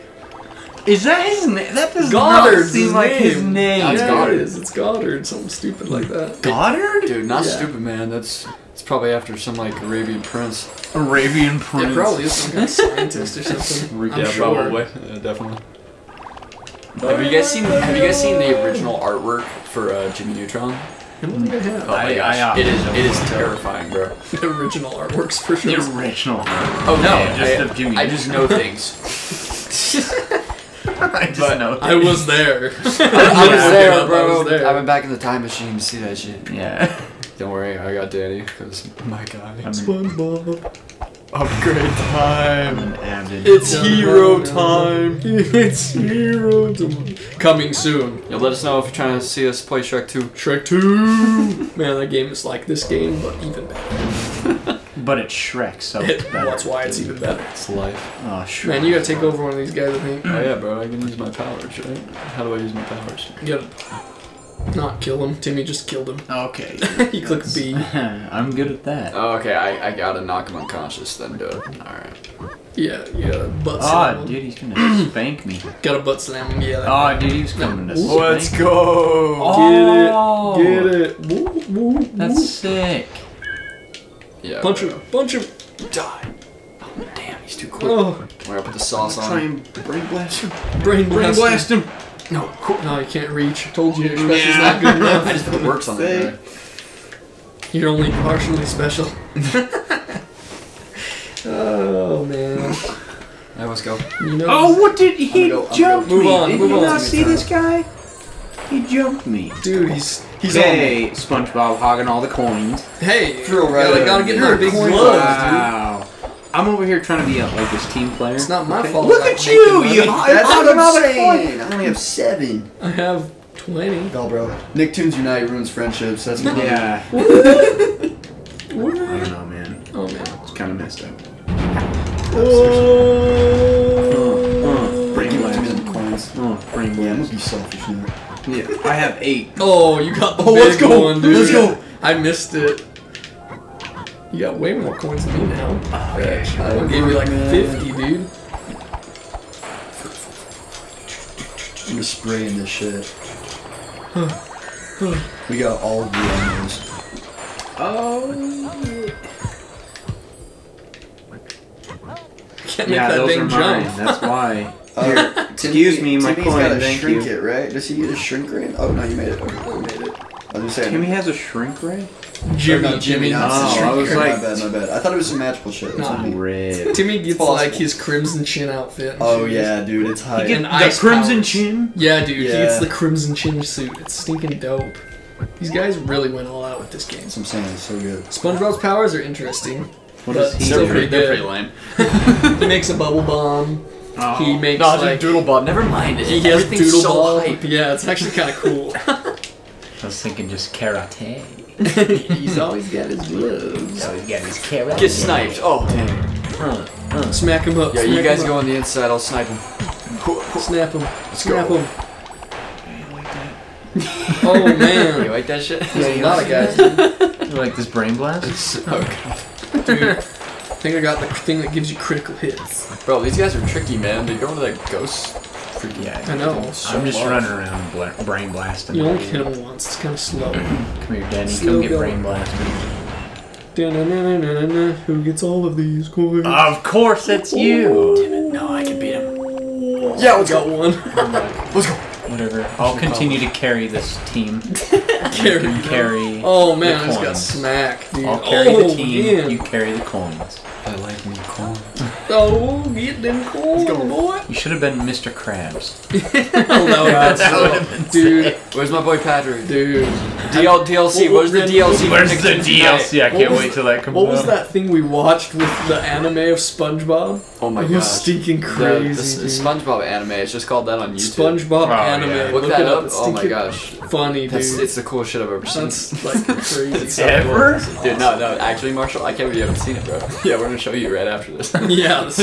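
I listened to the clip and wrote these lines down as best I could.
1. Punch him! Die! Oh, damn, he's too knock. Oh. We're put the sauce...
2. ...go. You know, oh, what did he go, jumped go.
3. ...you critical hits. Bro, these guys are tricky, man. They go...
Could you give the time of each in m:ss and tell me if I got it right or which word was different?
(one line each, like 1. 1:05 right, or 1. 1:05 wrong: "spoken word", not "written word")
1. 1:25 wrong: "quick", not "knock"
2. 1:43 right
3. 3:41 right.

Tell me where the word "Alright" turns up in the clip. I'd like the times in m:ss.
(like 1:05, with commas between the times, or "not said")
1:11.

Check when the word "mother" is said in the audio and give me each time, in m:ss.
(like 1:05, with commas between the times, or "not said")
not said.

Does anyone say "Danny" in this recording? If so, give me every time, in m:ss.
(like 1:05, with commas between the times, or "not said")
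0:38, 3:51.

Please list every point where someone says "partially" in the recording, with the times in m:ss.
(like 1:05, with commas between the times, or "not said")
1:38.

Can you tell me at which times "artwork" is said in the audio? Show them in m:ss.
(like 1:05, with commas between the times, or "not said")
0:18, 0:24.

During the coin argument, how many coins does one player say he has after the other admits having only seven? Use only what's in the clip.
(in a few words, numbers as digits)
20.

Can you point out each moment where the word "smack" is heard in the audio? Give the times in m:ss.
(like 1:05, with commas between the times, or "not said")
3:27, 4:07.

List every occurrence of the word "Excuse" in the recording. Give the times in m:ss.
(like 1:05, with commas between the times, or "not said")
2:45.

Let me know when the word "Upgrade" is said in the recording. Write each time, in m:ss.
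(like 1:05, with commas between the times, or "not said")
0:41.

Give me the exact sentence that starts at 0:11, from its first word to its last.
Yeah, probably is some kind of scientist or something.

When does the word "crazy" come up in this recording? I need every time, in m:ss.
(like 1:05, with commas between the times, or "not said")
4:28, 4:36.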